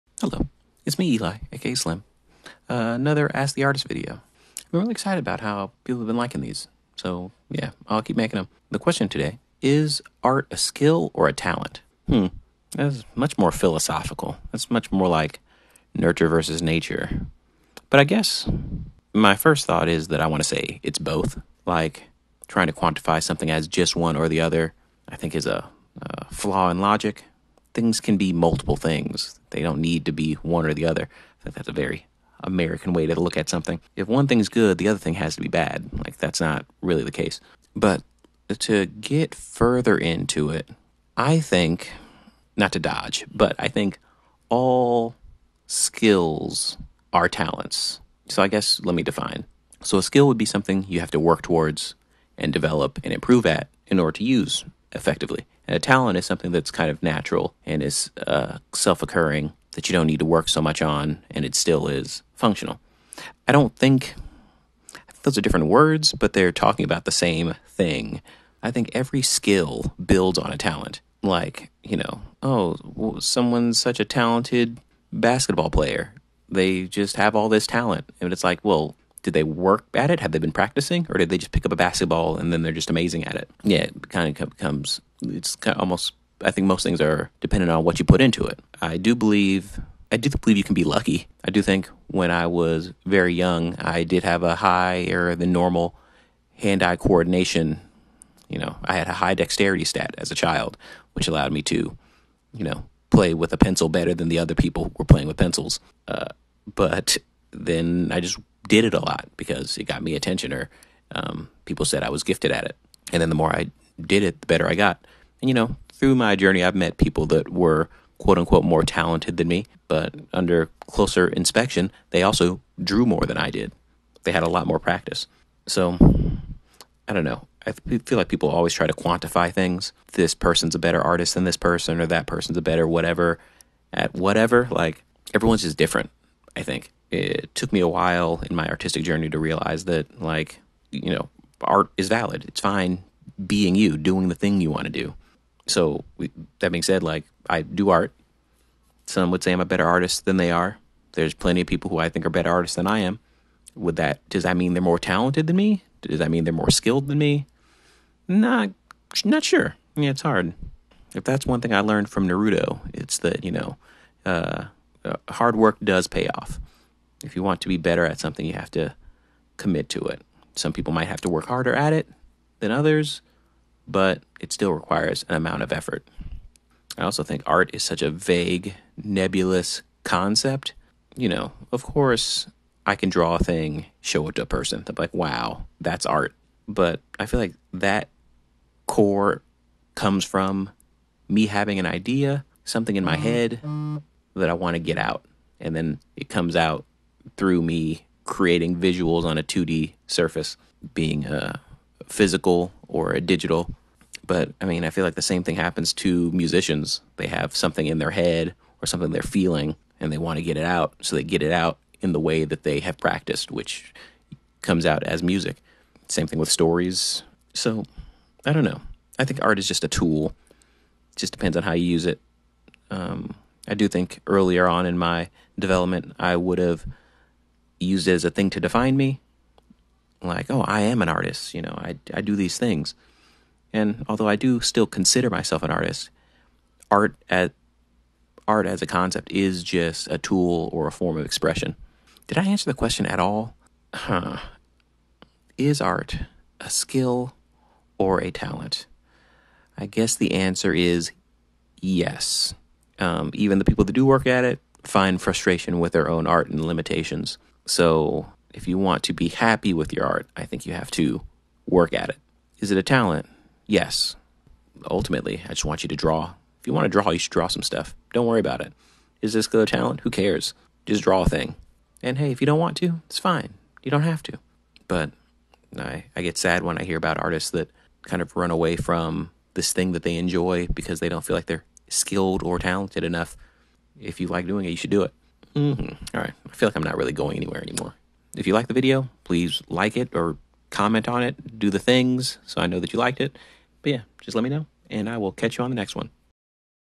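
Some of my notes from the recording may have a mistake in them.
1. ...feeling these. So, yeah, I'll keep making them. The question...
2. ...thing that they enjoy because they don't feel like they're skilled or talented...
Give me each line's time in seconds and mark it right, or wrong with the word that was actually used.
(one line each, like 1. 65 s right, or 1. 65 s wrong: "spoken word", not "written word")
1. 6 s wrong: "liking", not "feeling"
2. 279 s right.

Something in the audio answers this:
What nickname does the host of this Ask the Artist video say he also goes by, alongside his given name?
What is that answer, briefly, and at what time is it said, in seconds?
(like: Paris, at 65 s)
Slim, at 1 s.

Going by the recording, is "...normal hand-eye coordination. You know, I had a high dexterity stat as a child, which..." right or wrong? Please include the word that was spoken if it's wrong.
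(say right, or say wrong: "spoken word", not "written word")
right.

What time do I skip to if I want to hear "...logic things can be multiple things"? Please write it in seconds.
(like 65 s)
26 s.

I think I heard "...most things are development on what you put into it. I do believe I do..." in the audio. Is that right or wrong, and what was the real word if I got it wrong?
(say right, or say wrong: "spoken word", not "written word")
wrong: "dependent", not "development".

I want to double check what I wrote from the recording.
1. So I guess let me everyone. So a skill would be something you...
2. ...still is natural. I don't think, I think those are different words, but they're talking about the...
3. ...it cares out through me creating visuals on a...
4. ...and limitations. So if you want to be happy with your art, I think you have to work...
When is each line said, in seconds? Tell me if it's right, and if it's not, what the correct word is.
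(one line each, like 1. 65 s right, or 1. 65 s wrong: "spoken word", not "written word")
1. 48 s wrong: "define", not "everyone"
2. 61 s wrong: "functional", not "natural"
3. 196 s wrong: "comes", not "cares"
4. 256 s right.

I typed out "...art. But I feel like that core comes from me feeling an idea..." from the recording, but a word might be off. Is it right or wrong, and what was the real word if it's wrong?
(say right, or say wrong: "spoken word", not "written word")
wrong: "having", not "feeling".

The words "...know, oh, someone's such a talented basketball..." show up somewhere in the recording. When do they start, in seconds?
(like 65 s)
71 s.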